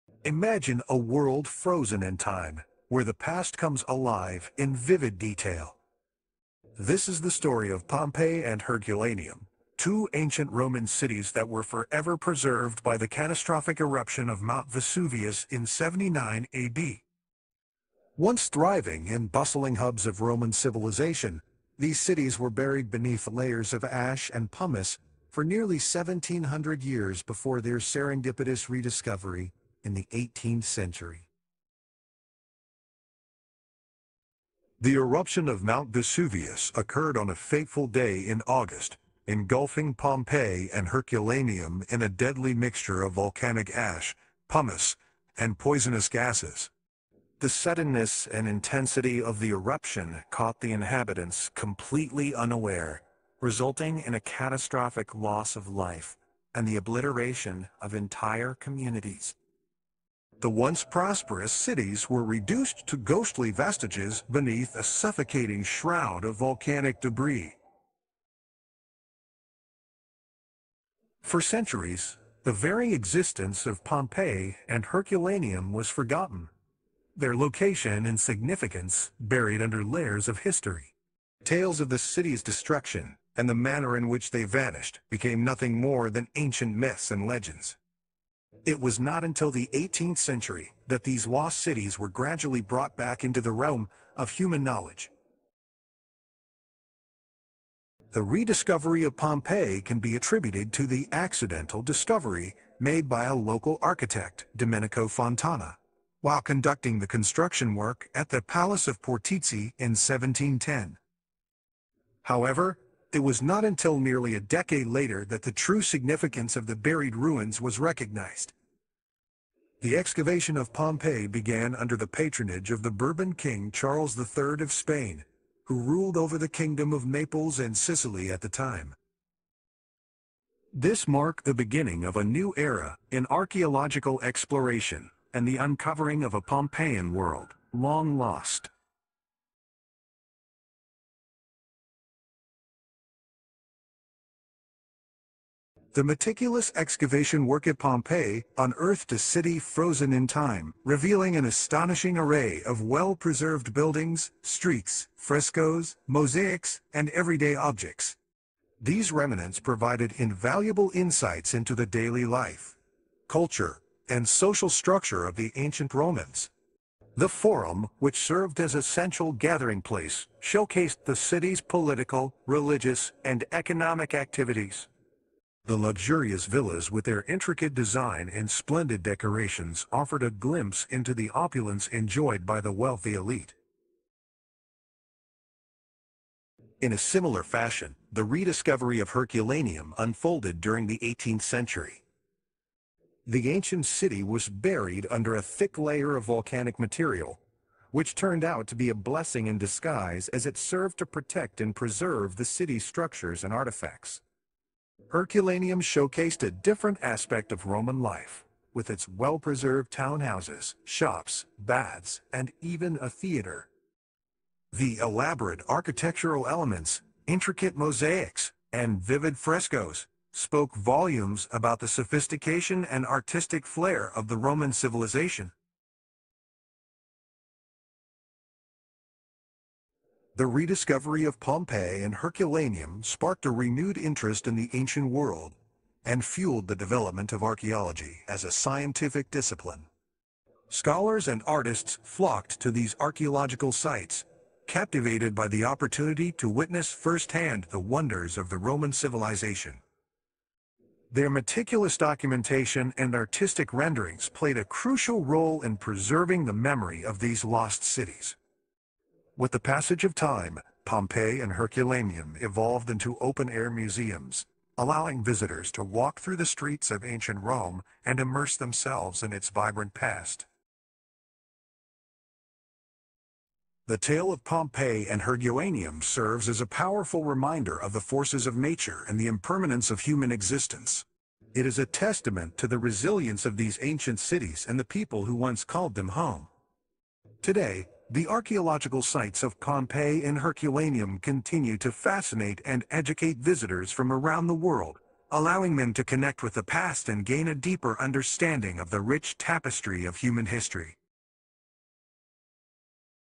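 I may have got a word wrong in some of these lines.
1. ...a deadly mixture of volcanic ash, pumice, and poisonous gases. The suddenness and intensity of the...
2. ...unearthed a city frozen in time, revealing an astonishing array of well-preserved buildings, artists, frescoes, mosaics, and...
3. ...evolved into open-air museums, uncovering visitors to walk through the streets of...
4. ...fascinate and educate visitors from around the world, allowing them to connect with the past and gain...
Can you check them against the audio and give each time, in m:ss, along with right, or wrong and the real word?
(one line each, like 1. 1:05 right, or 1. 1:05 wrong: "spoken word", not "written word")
1. 0:42 right
2. 2:28 wrong: "streets", not "artists"
3. 4:22 wrong: "allowing", not "uncovering"
4. 4:51 right.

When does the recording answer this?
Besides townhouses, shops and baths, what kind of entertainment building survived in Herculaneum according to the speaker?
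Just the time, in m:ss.
3:33.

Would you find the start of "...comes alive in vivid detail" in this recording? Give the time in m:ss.
0:03.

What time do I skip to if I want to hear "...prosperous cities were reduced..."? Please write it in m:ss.
1:00.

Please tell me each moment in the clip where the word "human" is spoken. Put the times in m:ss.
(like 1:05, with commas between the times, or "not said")
1:34, 4:40, 5:00.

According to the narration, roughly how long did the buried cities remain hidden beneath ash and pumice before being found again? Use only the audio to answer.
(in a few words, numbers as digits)
nearly 1700 years.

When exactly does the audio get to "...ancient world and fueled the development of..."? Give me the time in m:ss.
3:54.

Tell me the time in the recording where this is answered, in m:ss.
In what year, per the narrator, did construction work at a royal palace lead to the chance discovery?
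1:49.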